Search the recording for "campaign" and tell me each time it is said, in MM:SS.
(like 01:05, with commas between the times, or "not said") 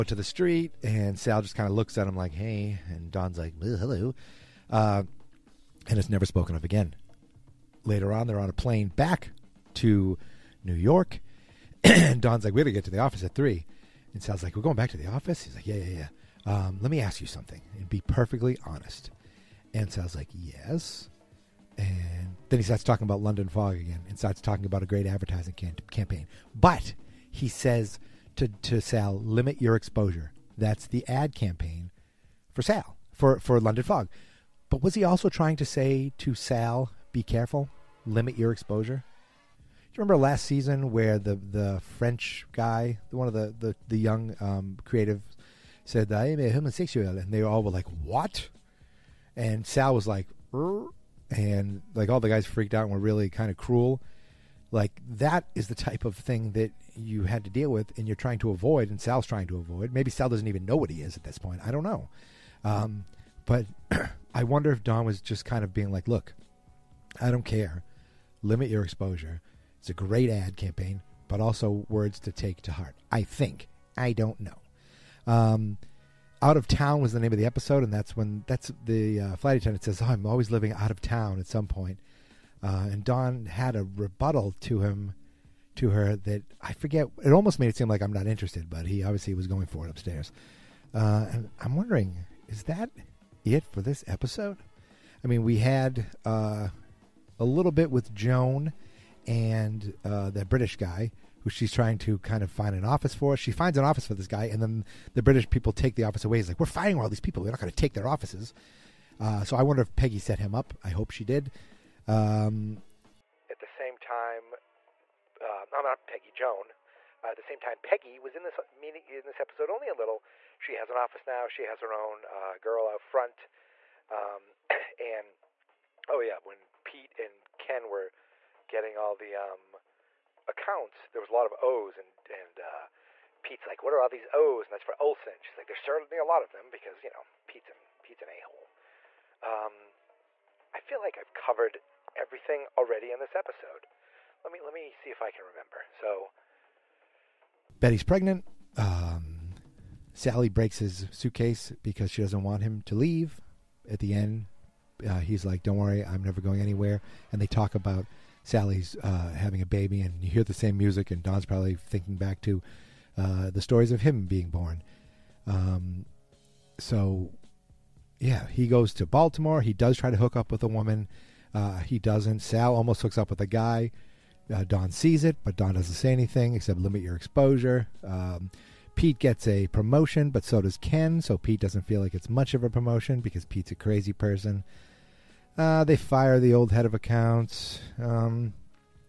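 00:25, 00:31, 01:10.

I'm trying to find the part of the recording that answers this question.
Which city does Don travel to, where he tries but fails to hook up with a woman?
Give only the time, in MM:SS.
02:49.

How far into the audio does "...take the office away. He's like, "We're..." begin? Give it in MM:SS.
01:45.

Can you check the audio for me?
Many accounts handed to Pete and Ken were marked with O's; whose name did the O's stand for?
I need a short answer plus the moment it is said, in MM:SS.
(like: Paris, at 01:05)
Olson, at 02:14.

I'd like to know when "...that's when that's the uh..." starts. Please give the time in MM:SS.
01:17.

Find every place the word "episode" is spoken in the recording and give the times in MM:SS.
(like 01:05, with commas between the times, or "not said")
01:17, 01:34, 01:59, 02:23.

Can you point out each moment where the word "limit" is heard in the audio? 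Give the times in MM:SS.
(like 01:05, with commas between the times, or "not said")
00:29, 00:38, 01:08, 02:56.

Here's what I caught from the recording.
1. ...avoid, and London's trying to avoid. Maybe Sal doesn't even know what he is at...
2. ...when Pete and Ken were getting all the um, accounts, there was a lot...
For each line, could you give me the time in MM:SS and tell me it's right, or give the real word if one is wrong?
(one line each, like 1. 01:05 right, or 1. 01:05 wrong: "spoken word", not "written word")
1. 00:58 wrong: "Sal", not "London"
2. 02:06 right.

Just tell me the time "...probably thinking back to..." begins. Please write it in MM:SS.
02:41.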